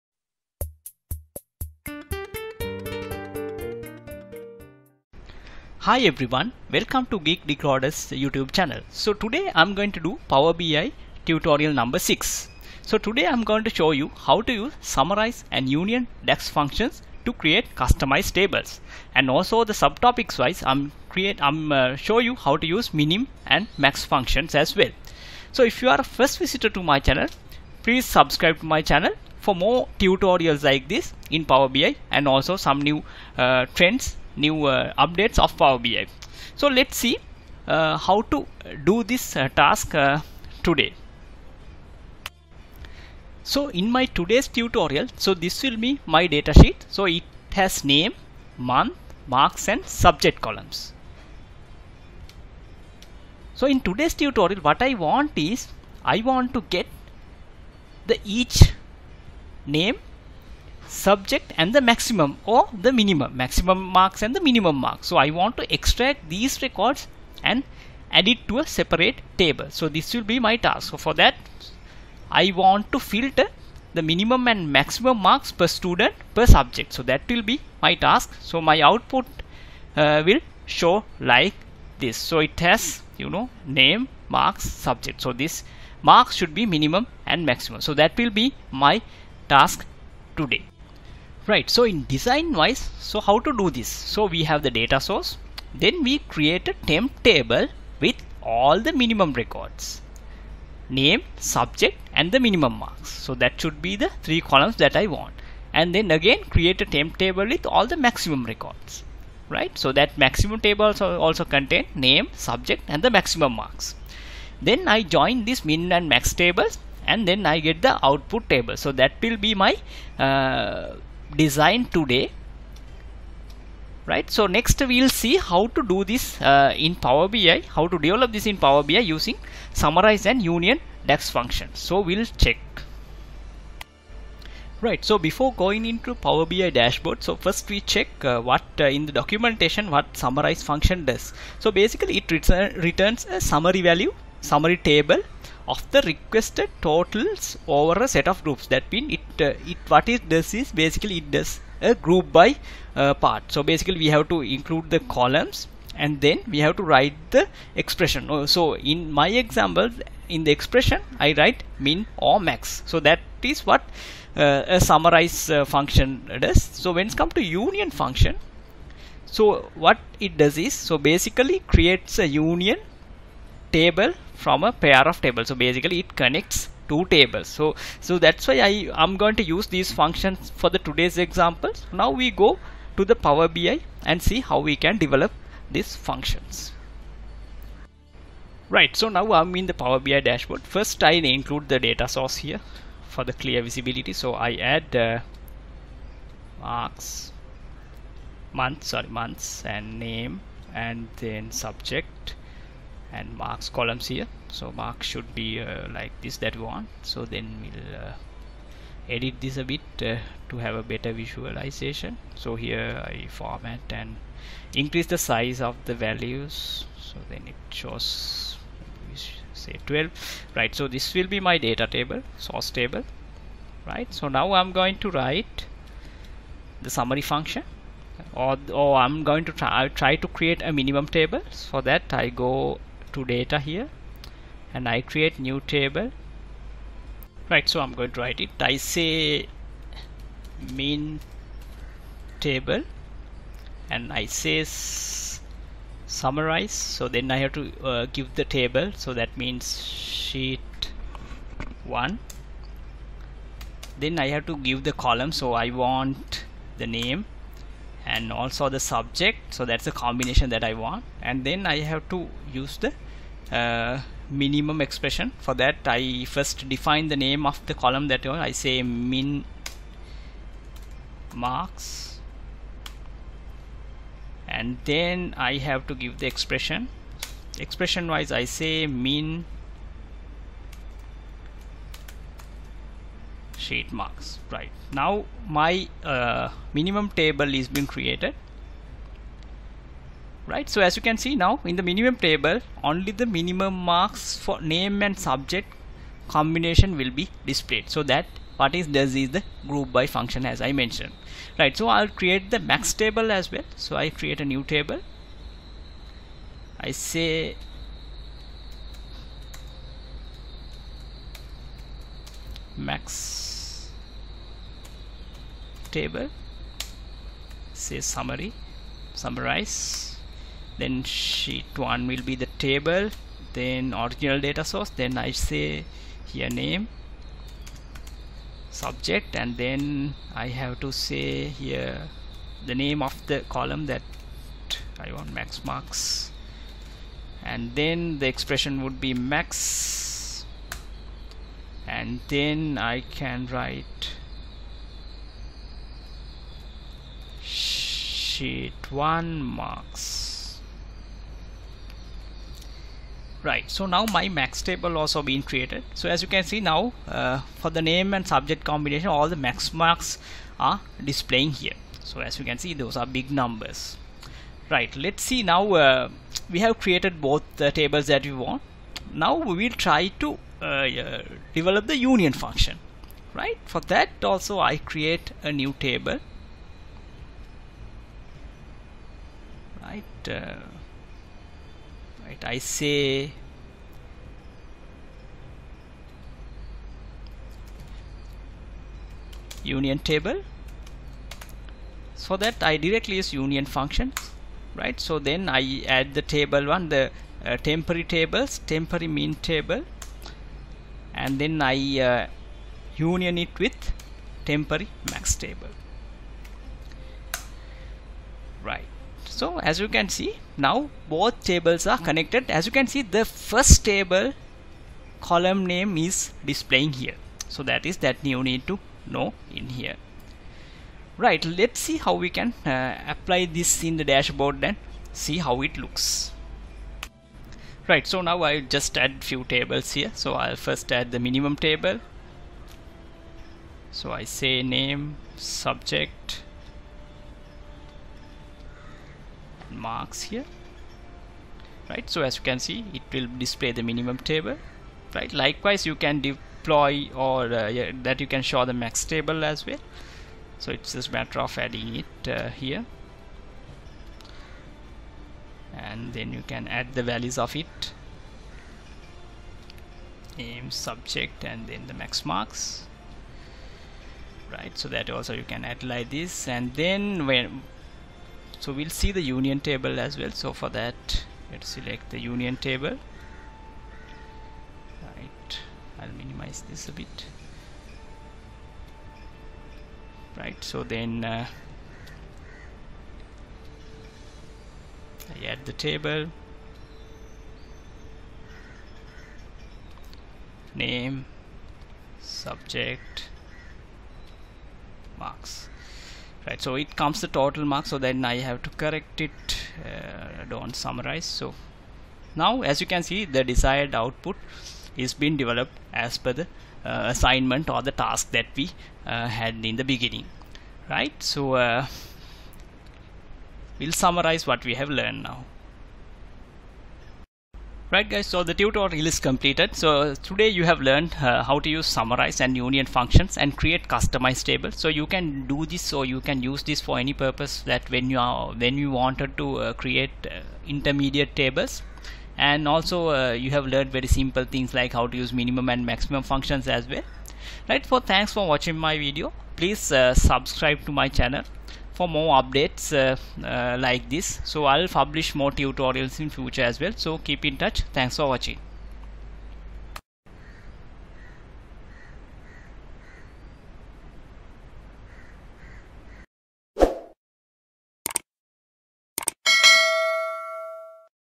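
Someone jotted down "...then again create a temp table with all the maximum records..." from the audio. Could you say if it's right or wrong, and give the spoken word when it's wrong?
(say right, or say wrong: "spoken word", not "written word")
right.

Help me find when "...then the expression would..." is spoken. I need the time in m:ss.
5:37.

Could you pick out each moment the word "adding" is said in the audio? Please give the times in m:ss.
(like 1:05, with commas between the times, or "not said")
7:31.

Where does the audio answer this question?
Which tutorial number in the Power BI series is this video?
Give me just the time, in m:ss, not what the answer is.
0:11.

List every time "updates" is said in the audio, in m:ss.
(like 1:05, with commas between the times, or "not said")
0:34, 9:02.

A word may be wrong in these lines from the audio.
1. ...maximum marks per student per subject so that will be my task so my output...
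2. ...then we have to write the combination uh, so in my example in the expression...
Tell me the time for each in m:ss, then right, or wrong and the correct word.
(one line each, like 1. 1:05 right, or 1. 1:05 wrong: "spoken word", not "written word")
1. 1:14 right
2. 2:36 wrong: "expression", not "combination".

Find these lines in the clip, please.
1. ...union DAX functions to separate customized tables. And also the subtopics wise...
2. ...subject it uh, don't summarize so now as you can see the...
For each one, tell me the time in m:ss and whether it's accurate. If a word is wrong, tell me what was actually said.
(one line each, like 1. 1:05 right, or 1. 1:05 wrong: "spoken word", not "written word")
1. 0:15 wrong: "create", not "separate"
2. 8:18 wrong: "correct", not "subject".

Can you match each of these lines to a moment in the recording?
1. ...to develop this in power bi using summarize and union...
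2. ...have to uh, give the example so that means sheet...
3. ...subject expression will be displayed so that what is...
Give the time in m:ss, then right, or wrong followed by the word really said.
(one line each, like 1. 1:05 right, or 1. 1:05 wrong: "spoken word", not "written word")
1. 2:07 right
2. 4:07 wrong: "table", not "example"
3. 4:55 wrong: "combination", not "expression".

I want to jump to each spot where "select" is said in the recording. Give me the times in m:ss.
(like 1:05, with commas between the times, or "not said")
7:51.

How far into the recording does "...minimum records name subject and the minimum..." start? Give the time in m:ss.
1:39.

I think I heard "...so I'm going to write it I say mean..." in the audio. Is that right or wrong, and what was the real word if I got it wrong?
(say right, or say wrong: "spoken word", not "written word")
right.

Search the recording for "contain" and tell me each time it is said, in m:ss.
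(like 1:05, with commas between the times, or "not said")
1:51.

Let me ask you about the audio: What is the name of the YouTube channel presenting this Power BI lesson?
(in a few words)
Geek Decoders.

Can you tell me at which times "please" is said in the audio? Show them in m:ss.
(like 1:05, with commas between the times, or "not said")
0:27, 8:59.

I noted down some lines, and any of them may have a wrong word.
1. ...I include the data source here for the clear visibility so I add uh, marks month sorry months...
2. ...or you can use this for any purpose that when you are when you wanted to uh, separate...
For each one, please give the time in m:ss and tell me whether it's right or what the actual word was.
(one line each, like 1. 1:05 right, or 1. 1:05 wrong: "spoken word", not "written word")
1. 3:11 right
2. 8:45 wrong: "create", not "separate".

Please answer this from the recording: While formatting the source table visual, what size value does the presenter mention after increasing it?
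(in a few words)
12.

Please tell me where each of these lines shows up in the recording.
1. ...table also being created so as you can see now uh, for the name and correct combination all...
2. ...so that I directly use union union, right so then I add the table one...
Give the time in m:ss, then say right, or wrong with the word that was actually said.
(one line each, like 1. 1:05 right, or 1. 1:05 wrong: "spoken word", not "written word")
1. 5:54 wrong: "subject", not "correct"
2. 6:32 wrong: "function", not "union".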